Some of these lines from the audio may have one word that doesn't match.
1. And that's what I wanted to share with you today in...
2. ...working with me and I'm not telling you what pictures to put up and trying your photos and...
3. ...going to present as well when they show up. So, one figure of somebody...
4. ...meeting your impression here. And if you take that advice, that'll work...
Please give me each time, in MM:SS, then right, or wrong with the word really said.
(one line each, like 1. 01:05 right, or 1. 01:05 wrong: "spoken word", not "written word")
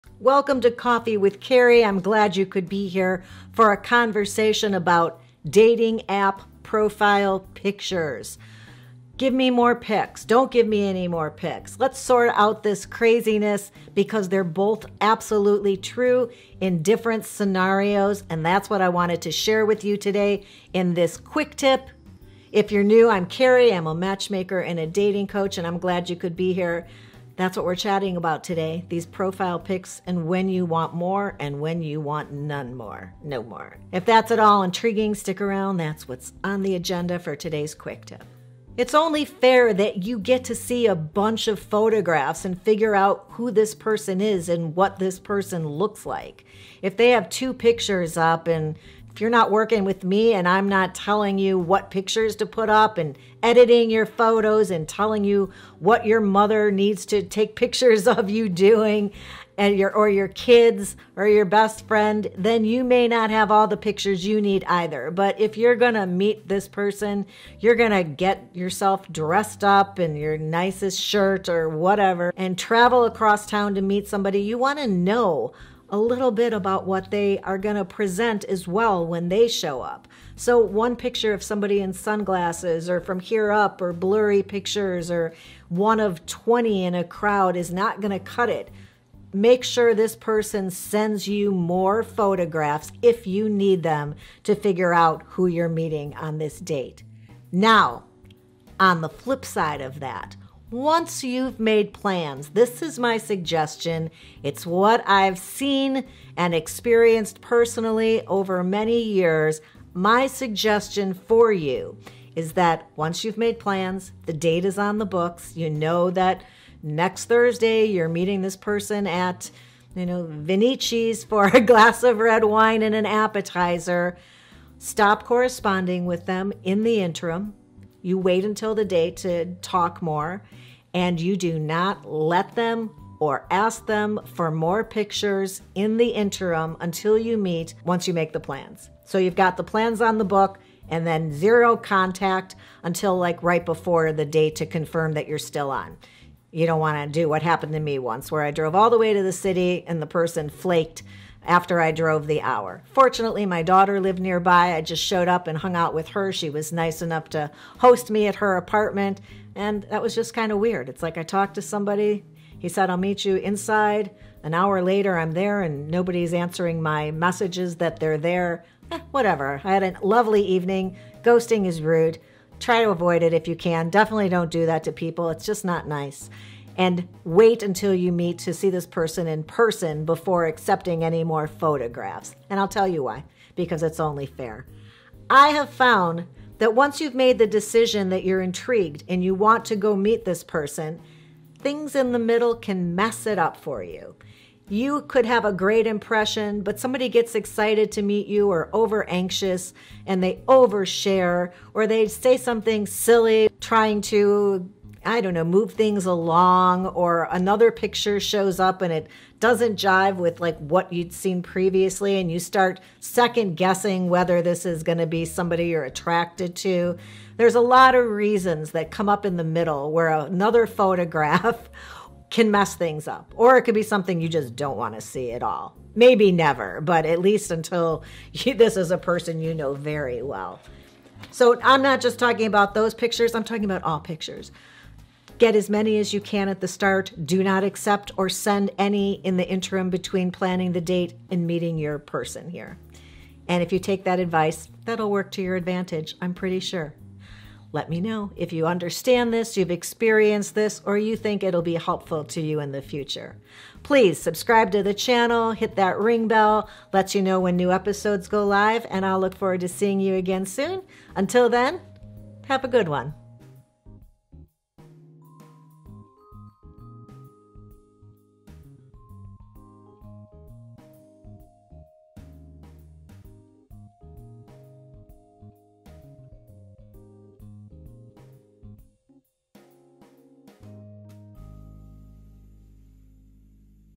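1. 00:18 right
2. 00:49 wrong: "editing", not "trying"
3. 01:17 wrong: "picture", not "figure"
4. 04:01 wrong: "person", not "impression".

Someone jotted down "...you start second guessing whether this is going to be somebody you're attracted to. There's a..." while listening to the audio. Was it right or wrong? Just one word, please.
right.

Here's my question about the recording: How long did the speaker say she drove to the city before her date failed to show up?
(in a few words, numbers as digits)
1 hour.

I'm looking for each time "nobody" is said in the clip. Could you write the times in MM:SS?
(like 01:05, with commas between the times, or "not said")
02:45.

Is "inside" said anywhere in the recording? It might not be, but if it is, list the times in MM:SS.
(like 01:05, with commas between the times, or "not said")
02:43.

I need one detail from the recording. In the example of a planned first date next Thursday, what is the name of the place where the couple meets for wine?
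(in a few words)
Vinici's.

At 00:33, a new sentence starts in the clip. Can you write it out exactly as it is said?
If that's at all intriguing, stick around.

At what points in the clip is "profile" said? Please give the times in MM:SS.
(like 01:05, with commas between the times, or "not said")
00:06, 00:29.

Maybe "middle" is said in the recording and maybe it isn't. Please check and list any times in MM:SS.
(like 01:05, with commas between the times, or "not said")
03:12, 03:39.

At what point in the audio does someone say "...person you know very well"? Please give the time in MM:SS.
03:48.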